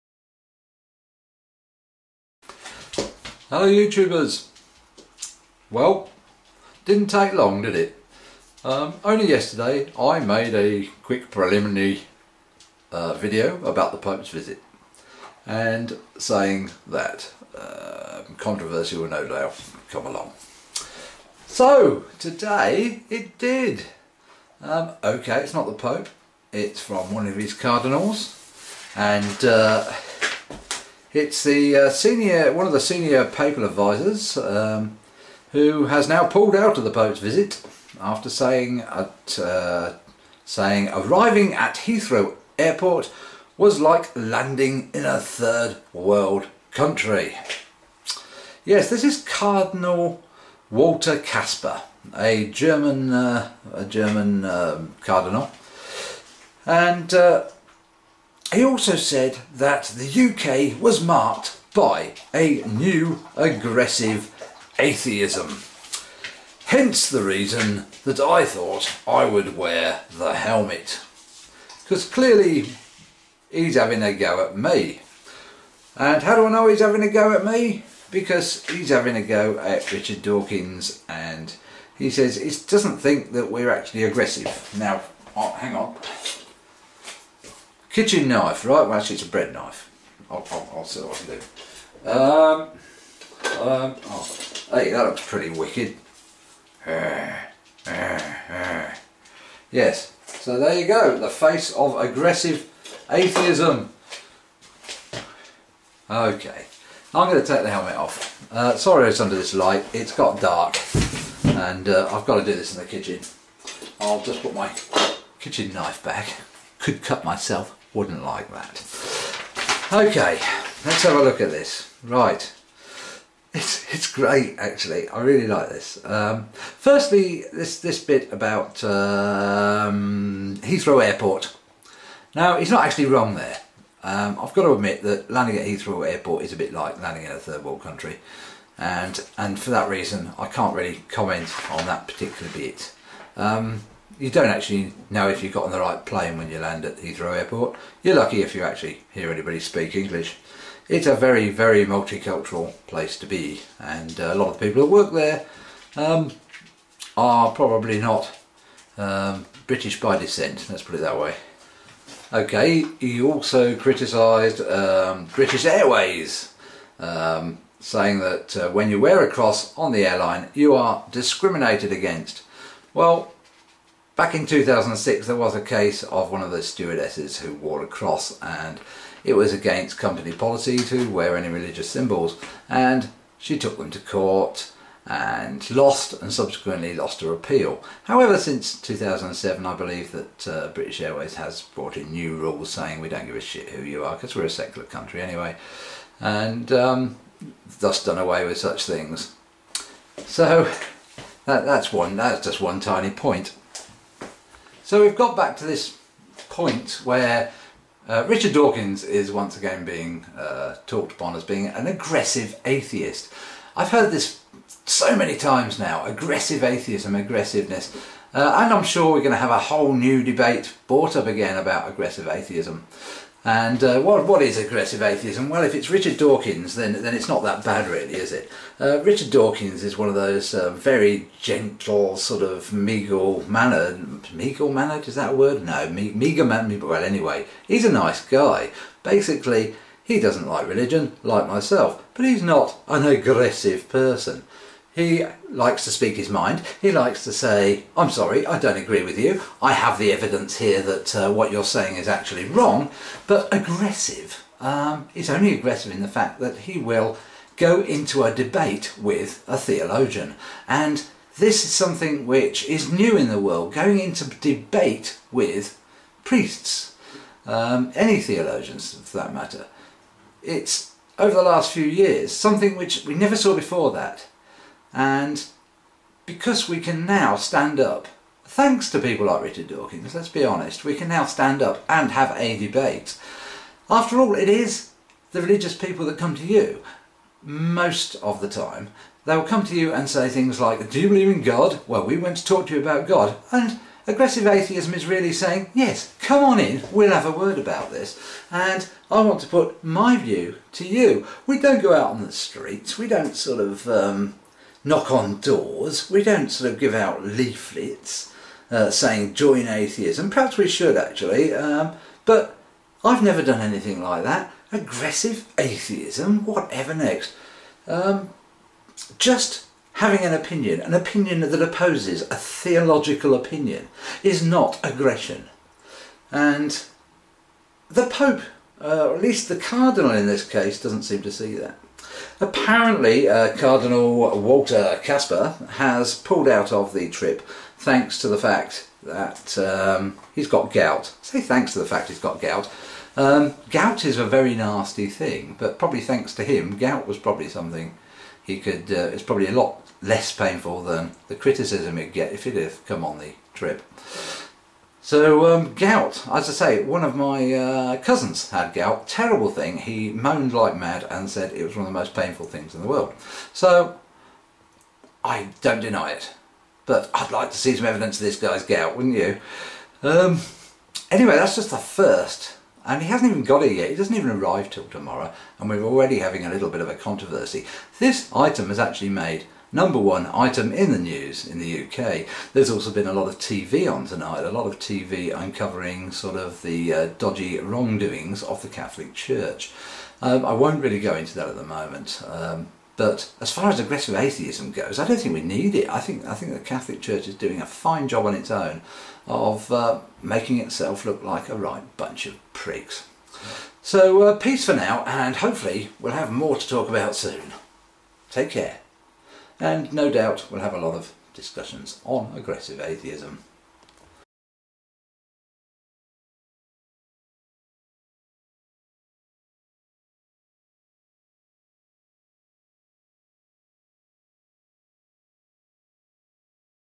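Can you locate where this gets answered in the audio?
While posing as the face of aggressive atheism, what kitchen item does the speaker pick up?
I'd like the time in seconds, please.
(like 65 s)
89 s.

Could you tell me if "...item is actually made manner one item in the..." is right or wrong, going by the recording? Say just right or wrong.
wrong.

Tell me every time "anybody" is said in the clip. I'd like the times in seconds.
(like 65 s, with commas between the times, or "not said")
149 s.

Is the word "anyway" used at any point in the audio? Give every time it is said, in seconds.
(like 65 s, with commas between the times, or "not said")
195 s, 237 s, 371 s.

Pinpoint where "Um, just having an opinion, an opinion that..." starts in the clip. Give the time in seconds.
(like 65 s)
317 s.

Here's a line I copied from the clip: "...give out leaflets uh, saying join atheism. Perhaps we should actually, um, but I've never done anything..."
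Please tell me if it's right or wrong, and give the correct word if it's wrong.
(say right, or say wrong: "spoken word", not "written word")
right.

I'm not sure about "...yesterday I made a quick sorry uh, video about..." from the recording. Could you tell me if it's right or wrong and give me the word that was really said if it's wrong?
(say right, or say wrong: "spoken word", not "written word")
wrong: "preliminary", not "sorry".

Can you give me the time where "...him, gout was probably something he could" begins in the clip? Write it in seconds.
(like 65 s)
346 s.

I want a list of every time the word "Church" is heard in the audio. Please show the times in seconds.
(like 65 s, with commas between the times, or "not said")
389 s, 397 s.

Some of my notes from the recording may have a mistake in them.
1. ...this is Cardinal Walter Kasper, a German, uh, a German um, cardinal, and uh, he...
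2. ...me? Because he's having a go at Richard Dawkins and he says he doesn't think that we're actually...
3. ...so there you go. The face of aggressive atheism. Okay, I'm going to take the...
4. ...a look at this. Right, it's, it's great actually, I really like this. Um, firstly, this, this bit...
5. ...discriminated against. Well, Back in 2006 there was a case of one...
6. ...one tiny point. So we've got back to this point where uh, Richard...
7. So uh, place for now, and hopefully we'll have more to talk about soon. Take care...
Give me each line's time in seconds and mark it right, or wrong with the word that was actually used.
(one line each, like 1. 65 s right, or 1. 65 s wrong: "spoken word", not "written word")
1. 48 s right
2. 77 s right
3. 100 s right
4. 121 s right
5. 171 s right
6. 202 s right
7. 403 s wrong: "peace", not "place".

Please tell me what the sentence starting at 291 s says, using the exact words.
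Well, we went to talk to you about God.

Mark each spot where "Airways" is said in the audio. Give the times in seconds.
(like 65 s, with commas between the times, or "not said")
165 s, 191 s.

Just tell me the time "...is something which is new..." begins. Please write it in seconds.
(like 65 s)
261 s.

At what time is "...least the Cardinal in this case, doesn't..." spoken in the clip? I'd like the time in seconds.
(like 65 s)
329 s.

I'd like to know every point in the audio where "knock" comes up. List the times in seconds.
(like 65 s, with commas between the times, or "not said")
304 s.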